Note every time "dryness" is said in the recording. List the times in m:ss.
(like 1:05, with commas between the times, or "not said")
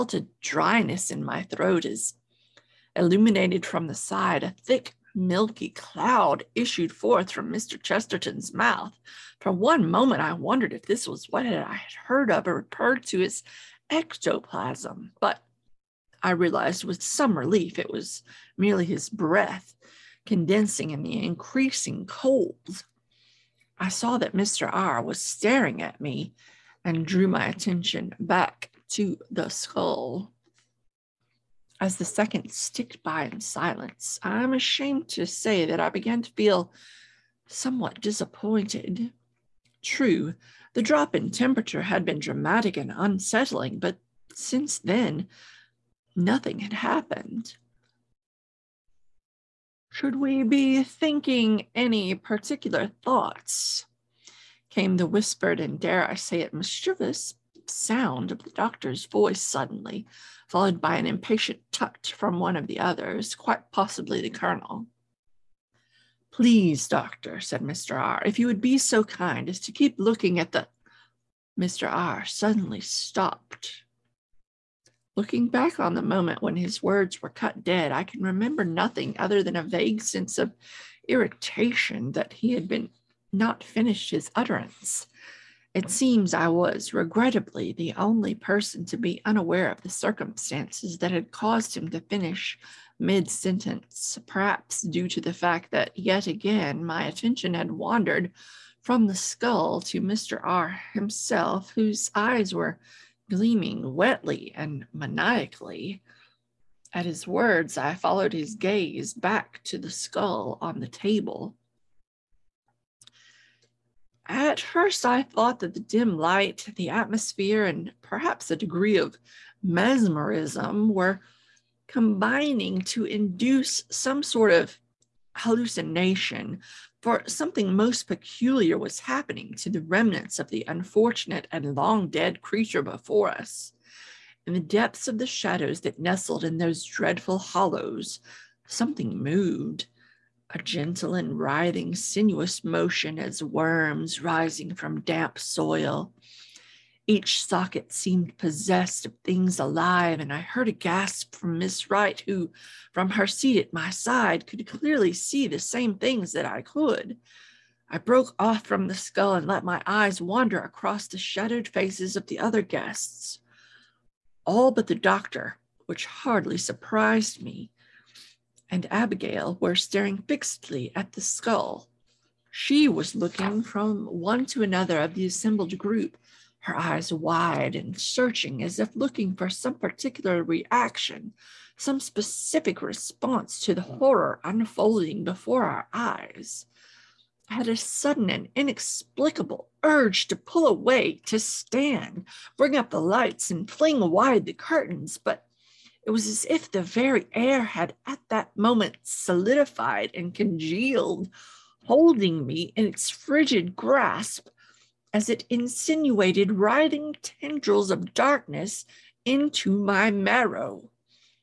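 0:00.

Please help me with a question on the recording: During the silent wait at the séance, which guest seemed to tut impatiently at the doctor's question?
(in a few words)
the colonel.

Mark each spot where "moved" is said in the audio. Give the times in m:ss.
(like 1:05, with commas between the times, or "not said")
2:19.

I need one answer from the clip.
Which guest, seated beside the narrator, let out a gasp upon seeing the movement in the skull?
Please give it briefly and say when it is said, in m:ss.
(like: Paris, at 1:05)
Miss Wright, at 2:31.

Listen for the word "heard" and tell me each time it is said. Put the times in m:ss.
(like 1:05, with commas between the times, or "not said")
0:12, 2:30.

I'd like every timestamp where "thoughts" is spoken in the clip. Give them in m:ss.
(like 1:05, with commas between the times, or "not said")
0:53, 1:55.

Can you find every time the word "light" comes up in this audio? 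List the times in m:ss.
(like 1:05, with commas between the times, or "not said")
1:56, 3:12.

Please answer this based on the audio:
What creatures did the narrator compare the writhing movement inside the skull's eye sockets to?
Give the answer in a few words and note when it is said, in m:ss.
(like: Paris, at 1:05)
worms, at 2:23.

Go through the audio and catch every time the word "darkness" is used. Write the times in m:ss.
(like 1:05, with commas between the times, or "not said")
3:28.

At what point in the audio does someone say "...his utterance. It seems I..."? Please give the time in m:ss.
1:24.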